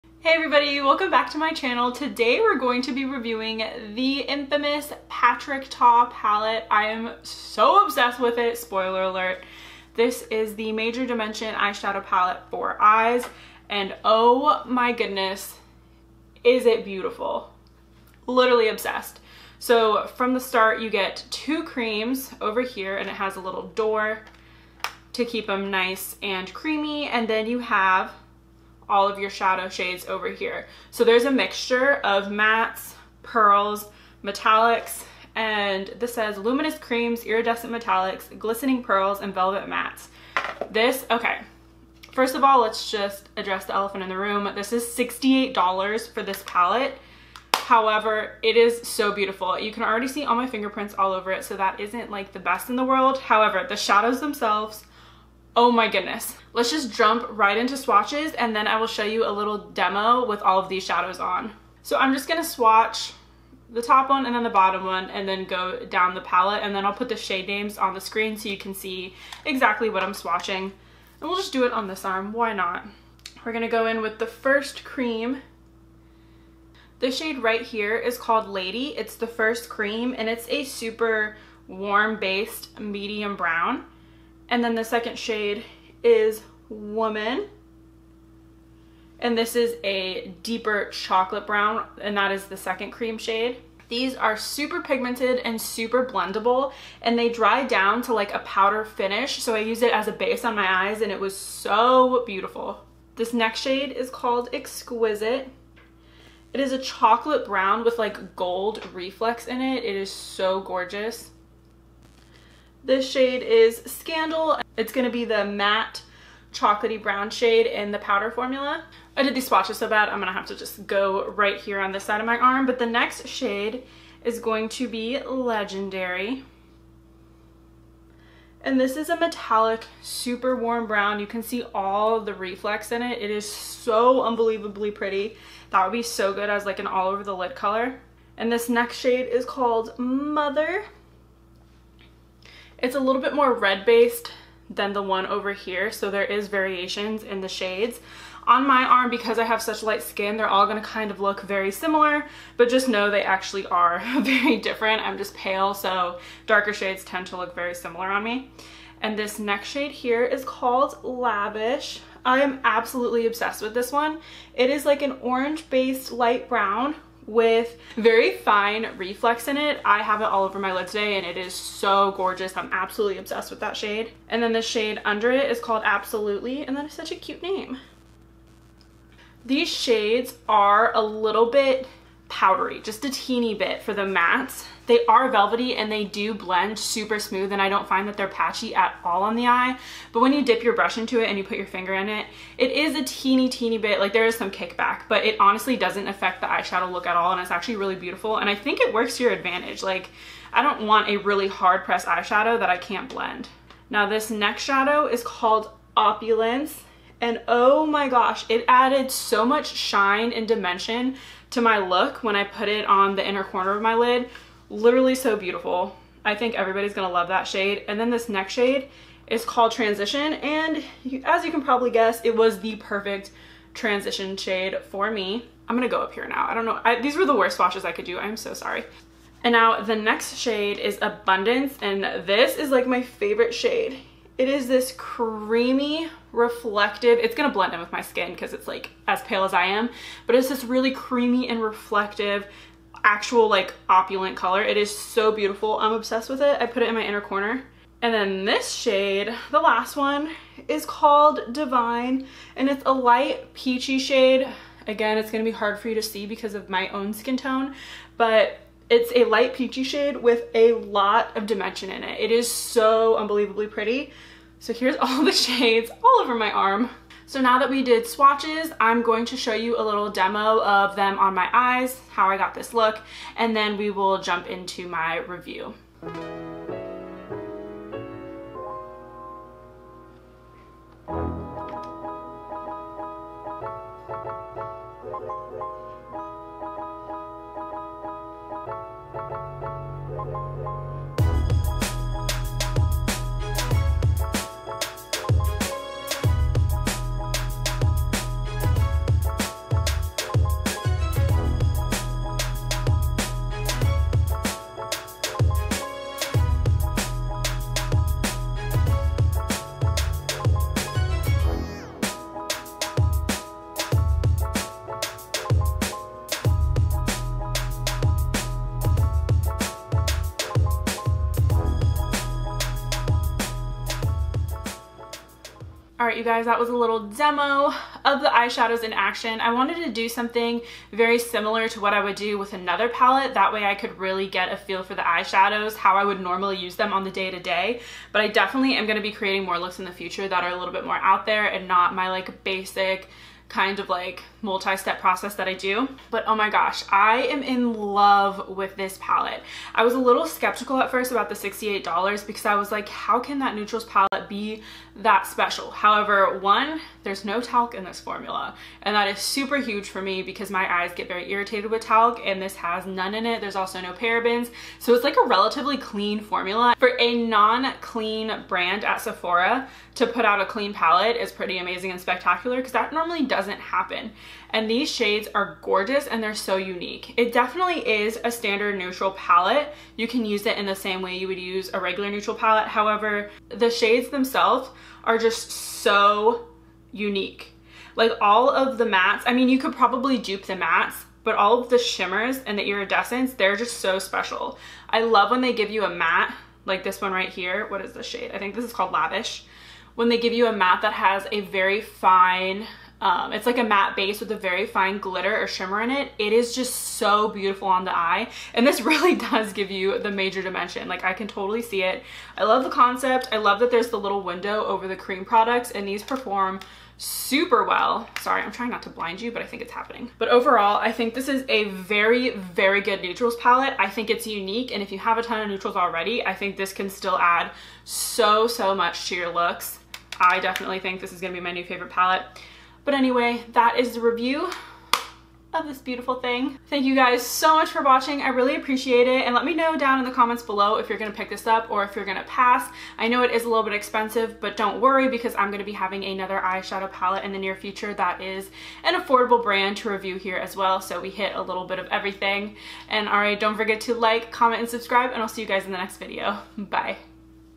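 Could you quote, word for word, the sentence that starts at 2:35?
I'm just pale, so darker shades tend to look very similar on me.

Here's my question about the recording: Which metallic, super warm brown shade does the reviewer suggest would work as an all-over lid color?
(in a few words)
Legendary.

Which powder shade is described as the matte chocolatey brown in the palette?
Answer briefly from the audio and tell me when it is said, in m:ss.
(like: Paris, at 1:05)
Scandal, at 1:53.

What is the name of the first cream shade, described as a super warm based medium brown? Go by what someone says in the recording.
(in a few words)
Lady.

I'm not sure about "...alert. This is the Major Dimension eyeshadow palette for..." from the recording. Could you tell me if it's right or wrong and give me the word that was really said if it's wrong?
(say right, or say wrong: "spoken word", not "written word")
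right.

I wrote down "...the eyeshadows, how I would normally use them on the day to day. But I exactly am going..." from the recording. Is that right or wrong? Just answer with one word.
wrong.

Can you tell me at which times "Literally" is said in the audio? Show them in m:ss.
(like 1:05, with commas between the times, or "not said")
0:18, 3:34.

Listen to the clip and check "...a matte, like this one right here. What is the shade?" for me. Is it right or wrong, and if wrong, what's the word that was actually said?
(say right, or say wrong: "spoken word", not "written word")
right.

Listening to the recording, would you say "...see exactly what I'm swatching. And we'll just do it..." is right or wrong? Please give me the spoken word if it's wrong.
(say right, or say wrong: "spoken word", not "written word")
right.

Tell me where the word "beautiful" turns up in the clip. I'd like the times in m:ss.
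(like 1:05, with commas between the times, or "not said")
0:16, 0:49, 1:42, 3:17, 3:35, 4:05, 6:47, 7:15.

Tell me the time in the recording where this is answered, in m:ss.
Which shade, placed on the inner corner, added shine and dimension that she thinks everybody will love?
3:25.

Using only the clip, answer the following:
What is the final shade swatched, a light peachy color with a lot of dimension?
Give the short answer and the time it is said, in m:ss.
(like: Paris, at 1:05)
Divine, at 4:11.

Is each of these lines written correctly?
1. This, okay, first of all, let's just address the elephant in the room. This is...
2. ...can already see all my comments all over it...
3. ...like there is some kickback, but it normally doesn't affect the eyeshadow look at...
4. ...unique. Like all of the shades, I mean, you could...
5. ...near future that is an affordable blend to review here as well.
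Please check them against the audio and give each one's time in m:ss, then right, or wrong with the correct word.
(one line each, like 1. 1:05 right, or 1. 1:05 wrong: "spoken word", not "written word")
1. 0:40 right
2. 0:49 wrong: "fingerprints", not "comments"
3. 3:13 wrong: "honestly", not "normally"
4. 6:26 wrong: "mattes", not "shades"
5. 7:27 wrong: "brand", not "blend".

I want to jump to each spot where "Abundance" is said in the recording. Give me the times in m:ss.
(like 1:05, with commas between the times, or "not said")
3:51.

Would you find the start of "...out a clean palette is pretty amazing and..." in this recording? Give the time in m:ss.
6:10.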